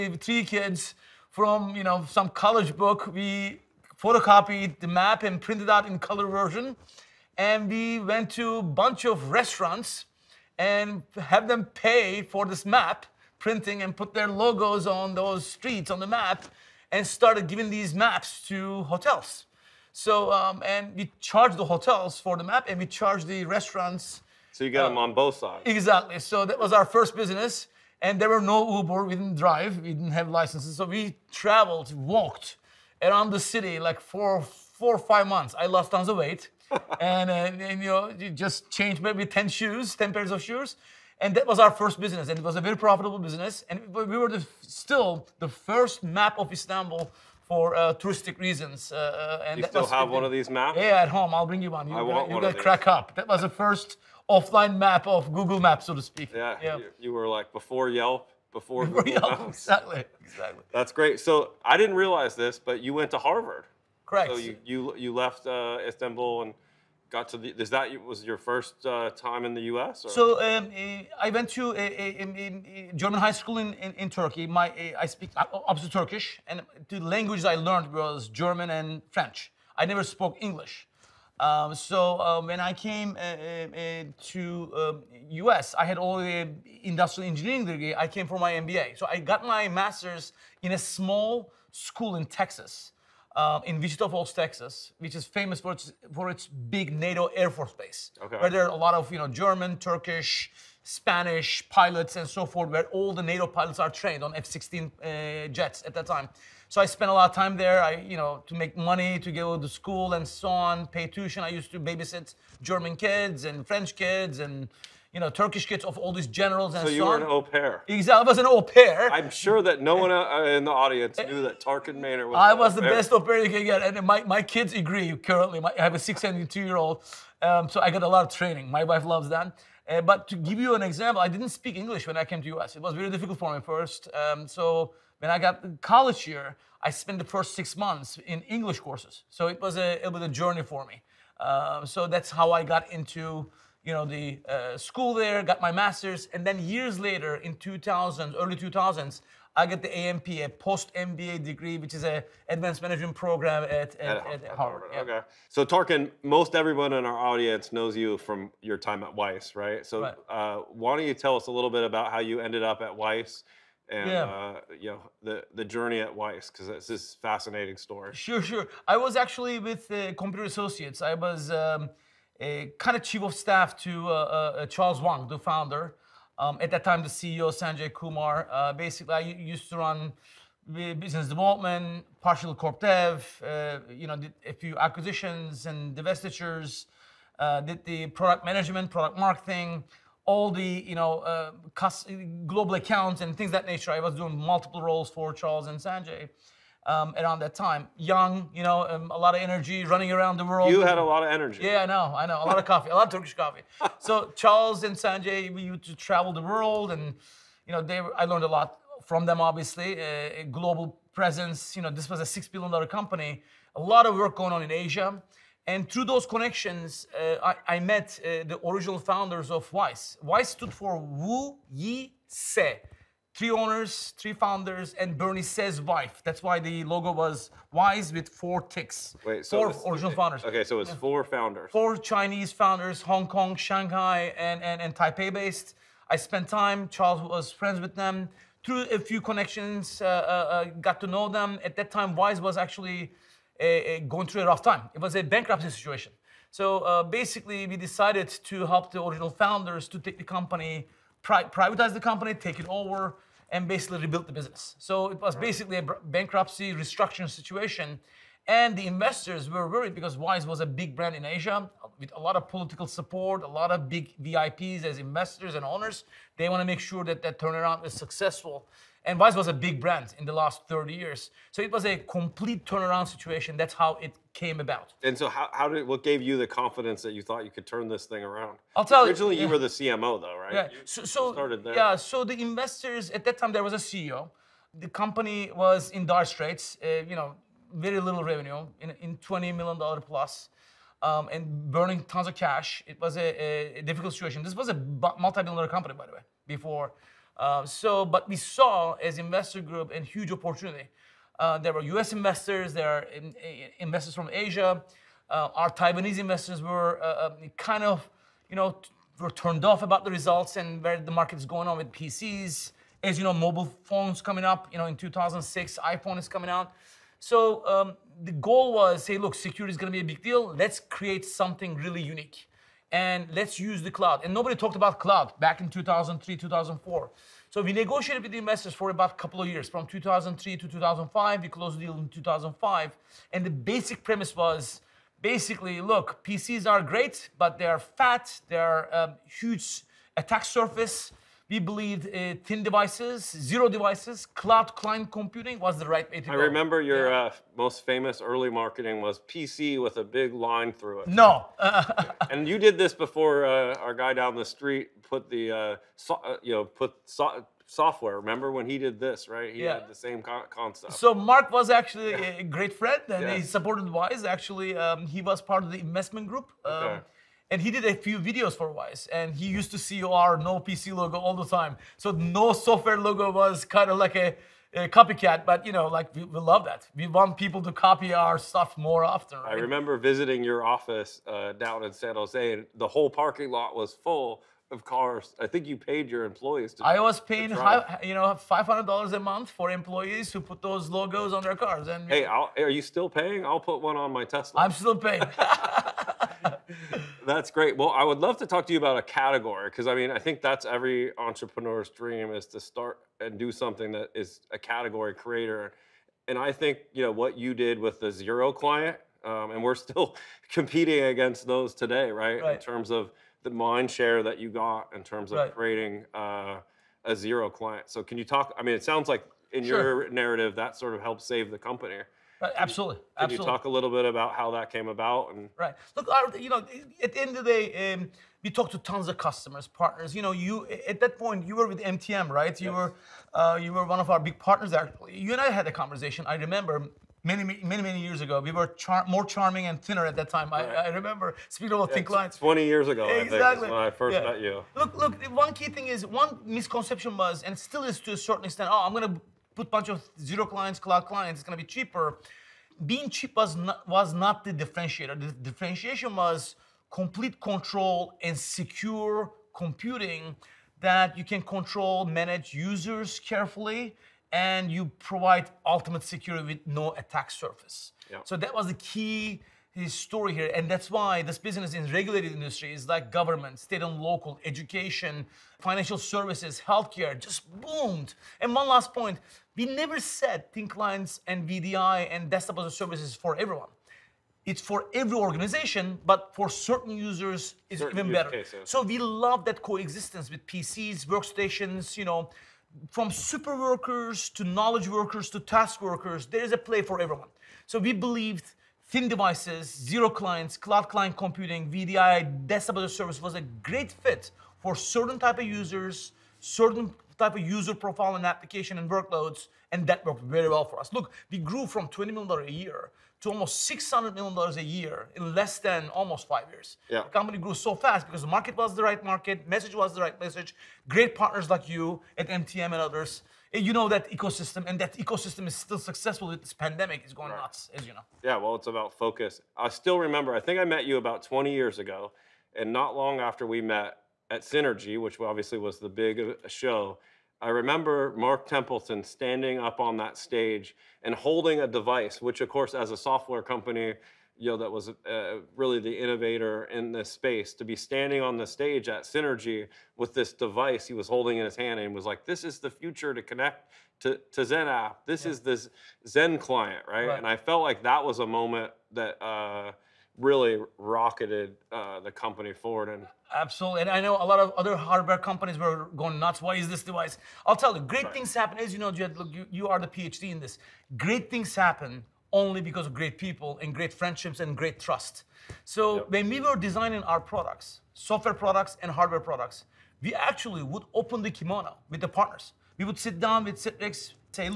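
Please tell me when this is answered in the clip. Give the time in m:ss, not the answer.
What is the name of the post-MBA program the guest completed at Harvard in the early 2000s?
2:32.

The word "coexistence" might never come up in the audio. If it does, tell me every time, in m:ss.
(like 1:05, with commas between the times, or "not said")
8:09.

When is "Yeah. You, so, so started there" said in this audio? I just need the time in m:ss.
4:40.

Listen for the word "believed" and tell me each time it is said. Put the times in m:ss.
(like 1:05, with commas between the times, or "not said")
5:41, 8:17.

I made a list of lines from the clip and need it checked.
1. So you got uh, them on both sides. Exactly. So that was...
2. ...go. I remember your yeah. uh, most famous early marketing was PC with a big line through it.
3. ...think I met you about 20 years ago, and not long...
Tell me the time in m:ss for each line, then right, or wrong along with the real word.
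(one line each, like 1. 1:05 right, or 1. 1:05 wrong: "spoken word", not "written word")
1. 0:24 right
2. 5:46 right
3. 8:50 right.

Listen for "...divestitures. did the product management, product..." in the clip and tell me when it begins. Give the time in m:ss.
3:05.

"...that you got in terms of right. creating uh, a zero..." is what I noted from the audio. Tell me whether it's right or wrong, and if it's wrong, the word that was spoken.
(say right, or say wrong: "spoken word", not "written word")
right.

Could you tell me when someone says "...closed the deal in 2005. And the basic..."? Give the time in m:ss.
5:31.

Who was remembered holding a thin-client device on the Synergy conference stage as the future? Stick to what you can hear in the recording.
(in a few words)
Mark Templeton.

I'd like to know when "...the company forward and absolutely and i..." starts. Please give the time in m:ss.
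9:21.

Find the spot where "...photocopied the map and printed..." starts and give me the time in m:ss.
0:04.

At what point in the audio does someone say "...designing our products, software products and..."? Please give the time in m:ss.
9:36.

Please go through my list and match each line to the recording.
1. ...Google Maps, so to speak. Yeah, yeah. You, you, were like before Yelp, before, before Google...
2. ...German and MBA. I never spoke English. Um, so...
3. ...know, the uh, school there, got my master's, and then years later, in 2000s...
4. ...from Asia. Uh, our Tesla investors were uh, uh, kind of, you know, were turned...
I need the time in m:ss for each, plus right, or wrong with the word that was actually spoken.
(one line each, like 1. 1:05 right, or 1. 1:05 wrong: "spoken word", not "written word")
1. 0:55 right
2. 1:18 wrong: "French", not "MBA"
3. 2:23 right
4. 5:04 wrong: "Taiwanese", not "Tesla".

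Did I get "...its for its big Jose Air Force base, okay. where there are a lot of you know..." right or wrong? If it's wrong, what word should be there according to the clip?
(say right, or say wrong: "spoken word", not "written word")
wrong: "NATO", not "Jose".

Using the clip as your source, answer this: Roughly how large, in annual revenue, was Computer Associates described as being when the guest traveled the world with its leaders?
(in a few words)
6 billion dollars.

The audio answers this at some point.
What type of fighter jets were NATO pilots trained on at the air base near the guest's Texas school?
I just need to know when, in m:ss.
1:44.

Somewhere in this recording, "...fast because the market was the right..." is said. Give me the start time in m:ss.
8:37.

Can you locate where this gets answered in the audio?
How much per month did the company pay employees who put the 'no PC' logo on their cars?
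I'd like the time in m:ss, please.
6:28.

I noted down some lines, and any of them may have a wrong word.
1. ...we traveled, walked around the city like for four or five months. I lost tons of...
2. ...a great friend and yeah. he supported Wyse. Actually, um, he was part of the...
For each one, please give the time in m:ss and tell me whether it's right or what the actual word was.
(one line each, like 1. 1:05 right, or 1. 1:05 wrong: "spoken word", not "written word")
1. 0:30 right
2. 6:02 right.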